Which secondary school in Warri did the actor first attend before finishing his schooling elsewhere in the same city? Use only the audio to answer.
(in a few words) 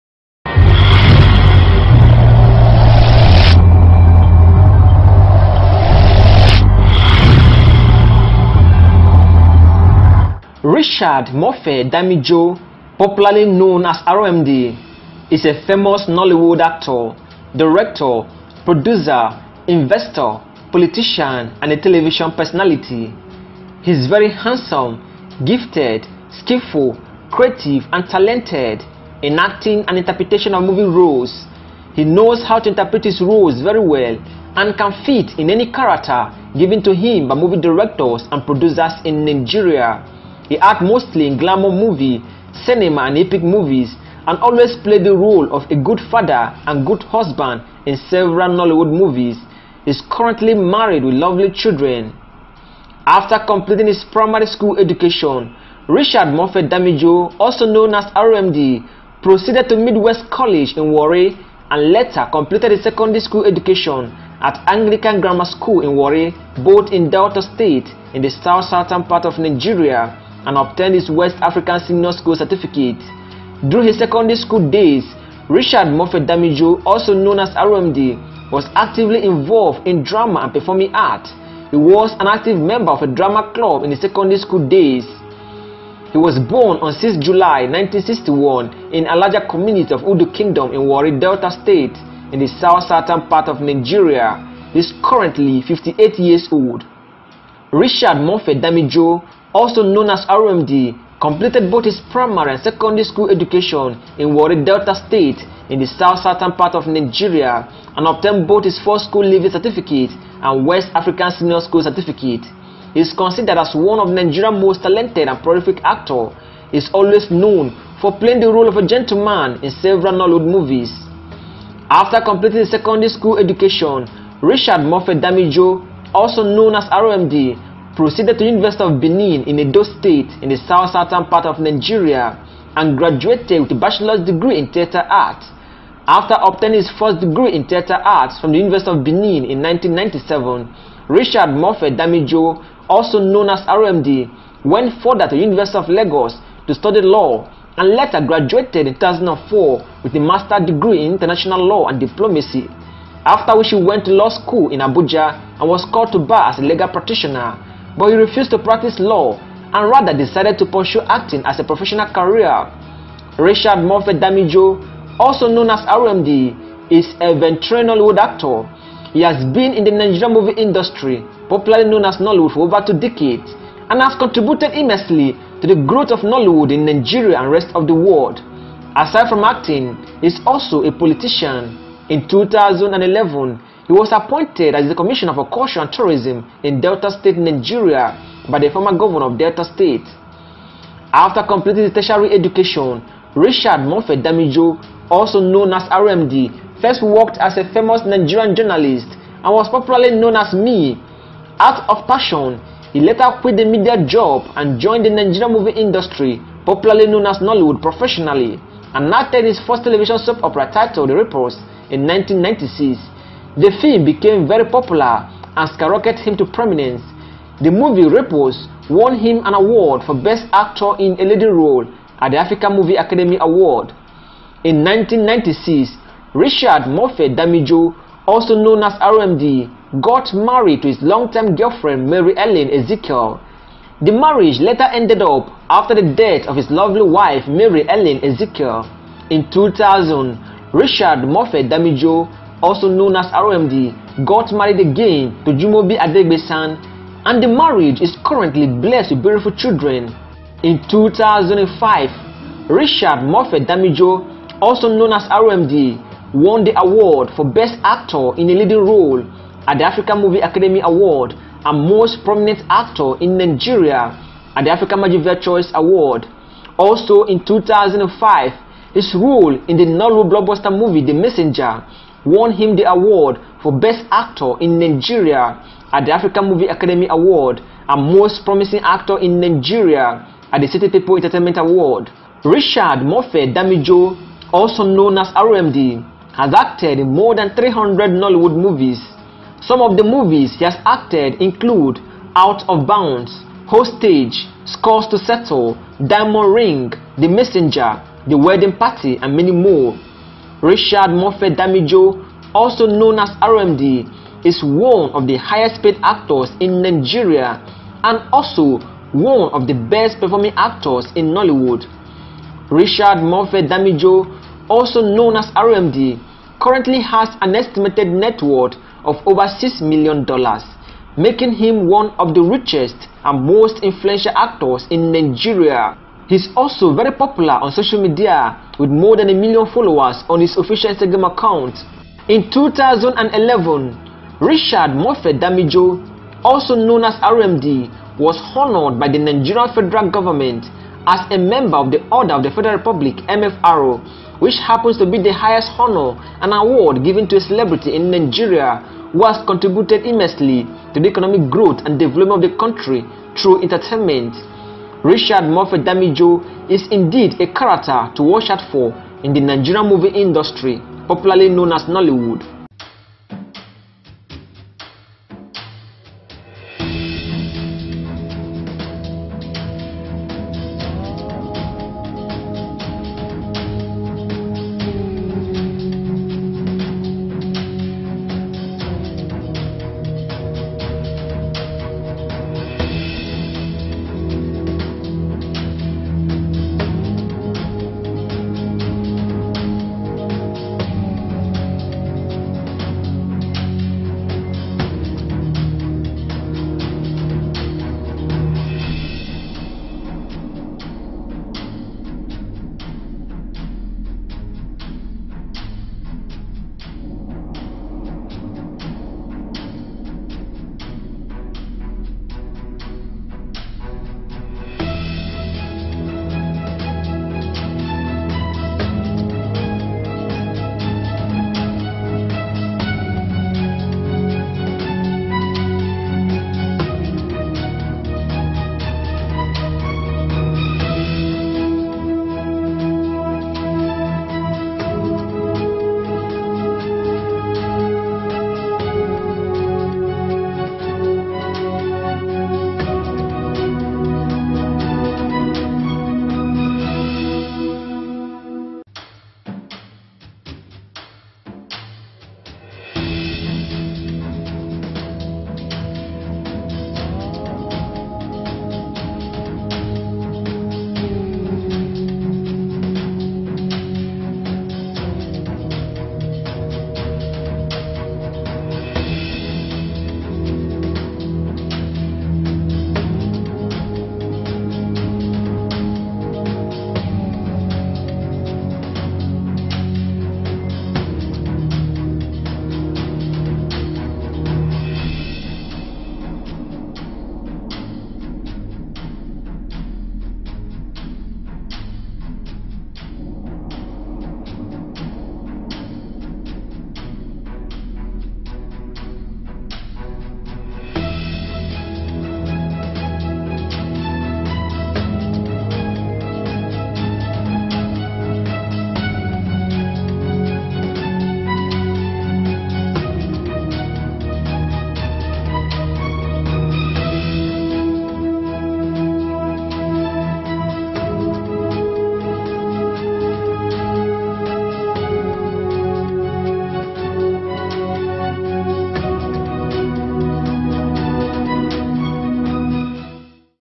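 Midwest College.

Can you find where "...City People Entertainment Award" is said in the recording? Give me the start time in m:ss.
4:40.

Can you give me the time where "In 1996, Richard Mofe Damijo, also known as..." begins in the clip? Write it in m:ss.
3:44.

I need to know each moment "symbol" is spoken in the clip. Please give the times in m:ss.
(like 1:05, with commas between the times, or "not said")
not said.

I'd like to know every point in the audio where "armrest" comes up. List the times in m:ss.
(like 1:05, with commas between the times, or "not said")
not said.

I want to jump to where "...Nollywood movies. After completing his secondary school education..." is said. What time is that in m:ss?
2:00.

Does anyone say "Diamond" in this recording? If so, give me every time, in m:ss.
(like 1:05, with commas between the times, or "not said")
4:56.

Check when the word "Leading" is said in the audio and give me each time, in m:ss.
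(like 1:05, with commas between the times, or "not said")
3:41, 4:18.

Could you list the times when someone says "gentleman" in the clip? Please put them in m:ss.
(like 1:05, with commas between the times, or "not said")
1:58.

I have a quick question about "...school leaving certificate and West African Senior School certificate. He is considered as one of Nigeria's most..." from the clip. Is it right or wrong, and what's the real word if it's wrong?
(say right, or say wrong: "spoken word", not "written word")
right.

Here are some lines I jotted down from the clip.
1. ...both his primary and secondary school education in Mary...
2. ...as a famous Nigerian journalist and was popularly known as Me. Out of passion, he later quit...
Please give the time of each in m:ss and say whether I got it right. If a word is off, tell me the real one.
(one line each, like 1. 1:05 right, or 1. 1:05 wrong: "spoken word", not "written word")
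1. 1:41 wrong: "Warri", not "Mary"
2. 3:17 right.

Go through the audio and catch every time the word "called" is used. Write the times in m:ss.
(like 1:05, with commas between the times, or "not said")
2:35.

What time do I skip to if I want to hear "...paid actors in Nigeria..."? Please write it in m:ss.
5:05.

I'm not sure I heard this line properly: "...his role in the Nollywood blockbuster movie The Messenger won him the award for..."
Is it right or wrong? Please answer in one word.
right.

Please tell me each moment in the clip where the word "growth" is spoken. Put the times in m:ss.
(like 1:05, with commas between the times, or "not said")
2:55, 5:51.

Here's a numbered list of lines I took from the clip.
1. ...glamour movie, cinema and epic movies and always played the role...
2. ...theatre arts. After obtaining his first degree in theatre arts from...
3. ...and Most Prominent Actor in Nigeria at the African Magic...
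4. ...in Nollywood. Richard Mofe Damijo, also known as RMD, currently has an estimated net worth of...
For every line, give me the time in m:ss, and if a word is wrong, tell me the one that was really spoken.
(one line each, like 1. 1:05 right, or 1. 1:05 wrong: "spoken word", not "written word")
1. 0:41 right
2. 2:14 right
3. 4:21 right
4. 5:11 right.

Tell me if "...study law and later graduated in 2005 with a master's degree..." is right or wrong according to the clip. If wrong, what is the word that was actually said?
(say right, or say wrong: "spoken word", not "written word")
wrong: "2004", not "2005".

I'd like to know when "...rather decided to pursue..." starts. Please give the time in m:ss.
2:39.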